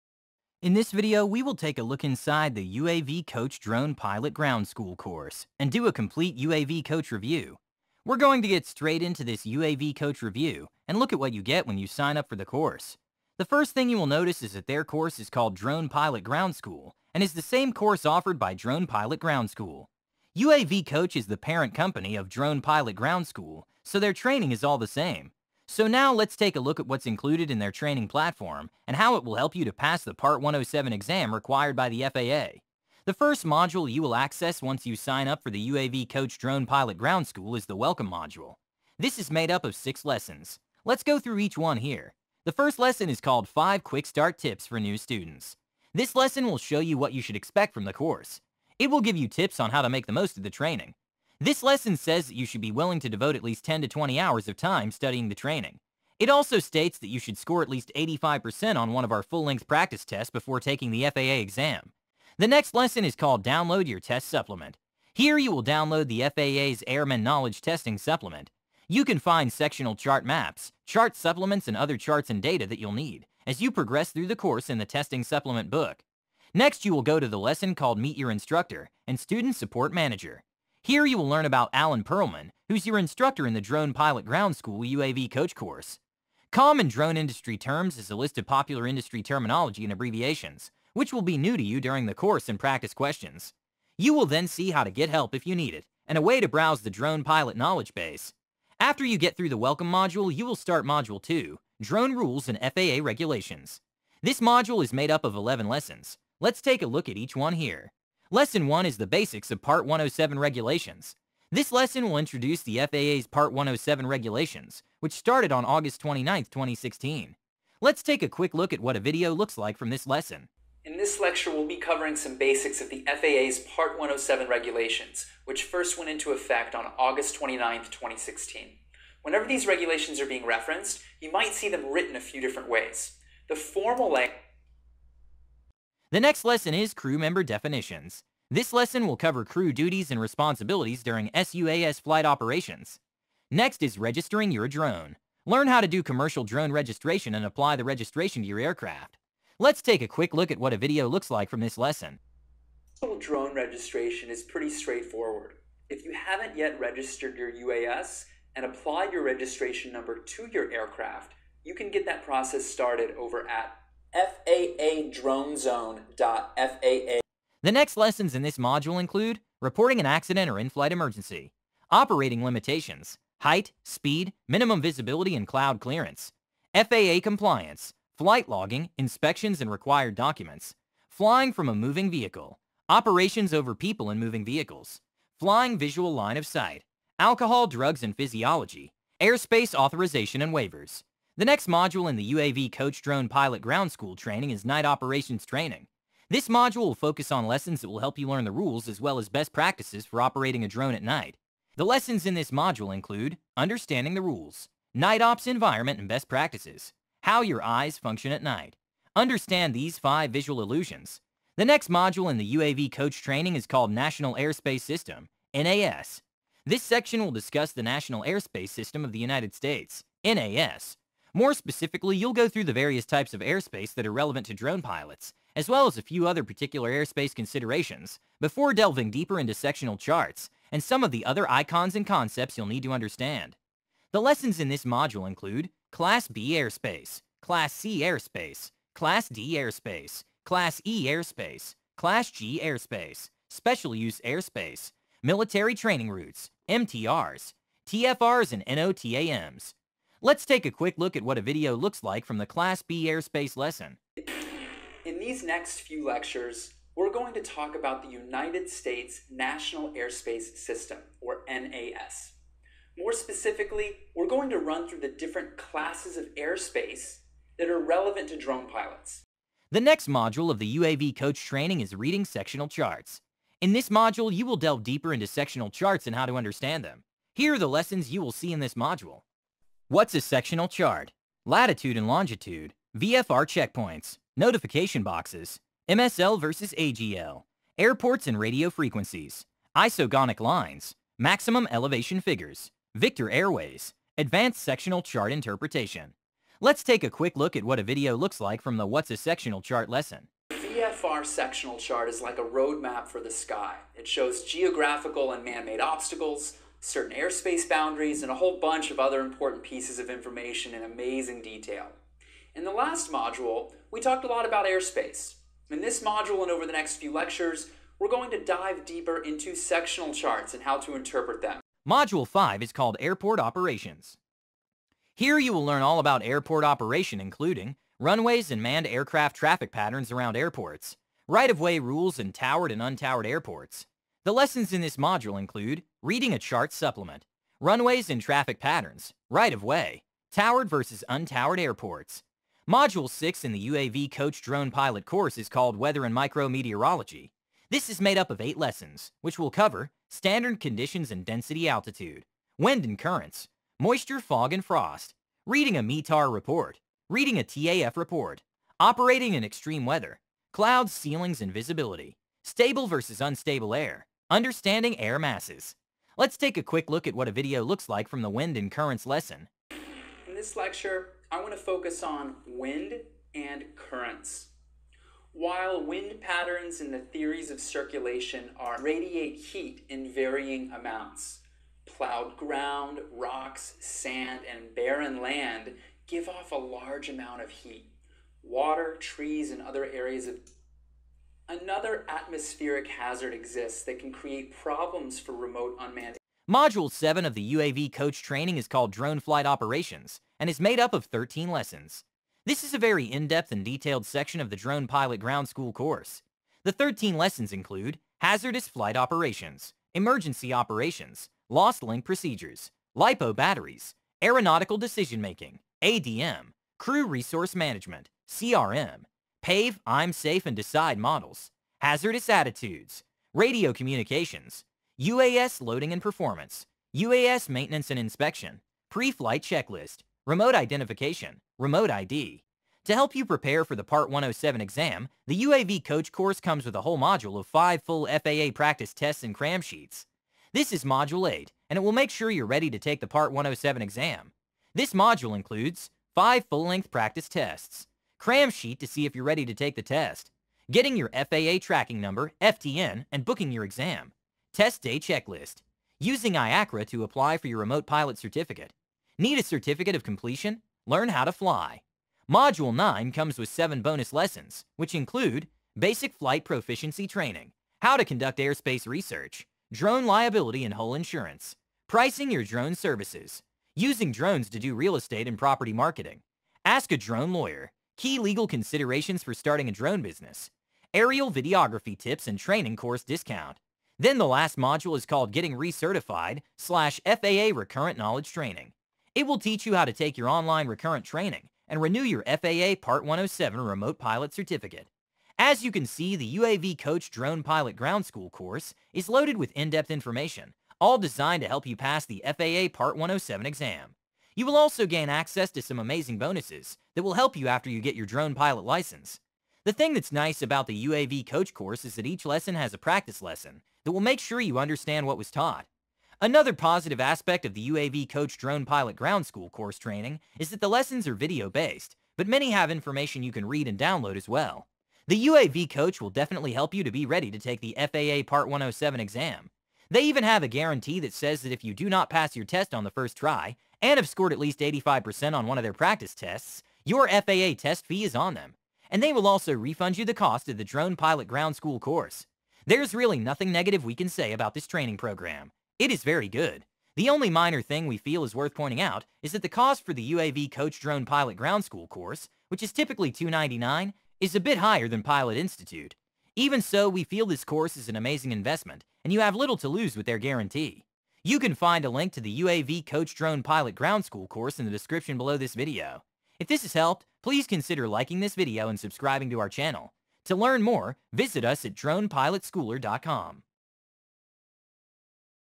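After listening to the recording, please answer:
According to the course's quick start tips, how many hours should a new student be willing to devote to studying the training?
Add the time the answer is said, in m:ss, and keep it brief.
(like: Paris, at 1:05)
10 to 20 hours, at 0:53.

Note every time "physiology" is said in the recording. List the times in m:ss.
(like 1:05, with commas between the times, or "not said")
3:08.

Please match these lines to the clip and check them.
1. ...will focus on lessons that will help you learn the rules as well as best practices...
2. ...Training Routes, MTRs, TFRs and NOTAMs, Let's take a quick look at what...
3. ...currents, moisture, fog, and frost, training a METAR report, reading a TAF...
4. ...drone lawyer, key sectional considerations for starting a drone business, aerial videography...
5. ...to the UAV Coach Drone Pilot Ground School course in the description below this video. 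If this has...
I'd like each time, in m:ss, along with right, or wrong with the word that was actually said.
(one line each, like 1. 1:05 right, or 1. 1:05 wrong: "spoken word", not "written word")
1. 3:16 right
2. 4:05 right
3. 5:52 wrong: "reading", not "training"
4. 7:56 wrong: "legal", not "sectional"
5. 9:22 right.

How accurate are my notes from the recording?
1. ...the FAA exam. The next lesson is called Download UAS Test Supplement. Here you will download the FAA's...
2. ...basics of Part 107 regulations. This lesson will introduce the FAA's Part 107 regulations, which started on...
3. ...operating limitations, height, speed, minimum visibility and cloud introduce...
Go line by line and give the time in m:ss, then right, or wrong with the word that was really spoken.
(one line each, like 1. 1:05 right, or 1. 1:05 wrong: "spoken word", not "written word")
1. 1:00 wrong: "Your", not "UAS"
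2. 1:49 right
3. 2:51 wrong: "clearance", not "introduce".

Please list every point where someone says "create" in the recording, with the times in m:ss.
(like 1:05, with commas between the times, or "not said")
6:34.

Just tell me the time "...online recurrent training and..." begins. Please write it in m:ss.
8:10.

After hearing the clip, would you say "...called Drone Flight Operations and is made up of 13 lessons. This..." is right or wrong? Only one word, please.
right.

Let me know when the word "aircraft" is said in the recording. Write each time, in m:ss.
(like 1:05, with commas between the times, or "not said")
2:28, 2:40, 5:28.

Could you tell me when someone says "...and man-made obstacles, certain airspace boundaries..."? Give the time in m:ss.
5:05.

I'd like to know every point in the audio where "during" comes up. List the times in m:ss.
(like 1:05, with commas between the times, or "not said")
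1:31, 2:21.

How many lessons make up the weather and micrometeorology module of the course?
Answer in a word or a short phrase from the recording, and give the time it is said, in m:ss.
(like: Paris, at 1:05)
8, at 5:48.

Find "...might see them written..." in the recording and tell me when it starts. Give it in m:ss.
2:11.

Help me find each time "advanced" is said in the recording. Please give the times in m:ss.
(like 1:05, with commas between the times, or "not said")
4:54.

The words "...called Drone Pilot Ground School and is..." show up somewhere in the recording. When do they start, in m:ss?
0:15.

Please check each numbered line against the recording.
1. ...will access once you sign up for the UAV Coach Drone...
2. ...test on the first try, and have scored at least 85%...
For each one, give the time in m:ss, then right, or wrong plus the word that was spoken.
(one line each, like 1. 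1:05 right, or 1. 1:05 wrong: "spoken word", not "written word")
1. 0:34 right
2. 8:52 right.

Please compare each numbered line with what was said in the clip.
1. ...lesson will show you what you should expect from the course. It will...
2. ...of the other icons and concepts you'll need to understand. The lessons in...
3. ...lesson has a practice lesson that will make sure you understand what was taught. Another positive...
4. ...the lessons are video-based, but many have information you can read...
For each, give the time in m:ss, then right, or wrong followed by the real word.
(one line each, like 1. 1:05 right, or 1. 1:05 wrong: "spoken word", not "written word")
1. 0:46 right
2. 3:51 right
3. 8:32 right
4. 8:40 right.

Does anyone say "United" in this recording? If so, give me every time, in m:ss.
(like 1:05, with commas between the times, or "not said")
3:39, 4:18.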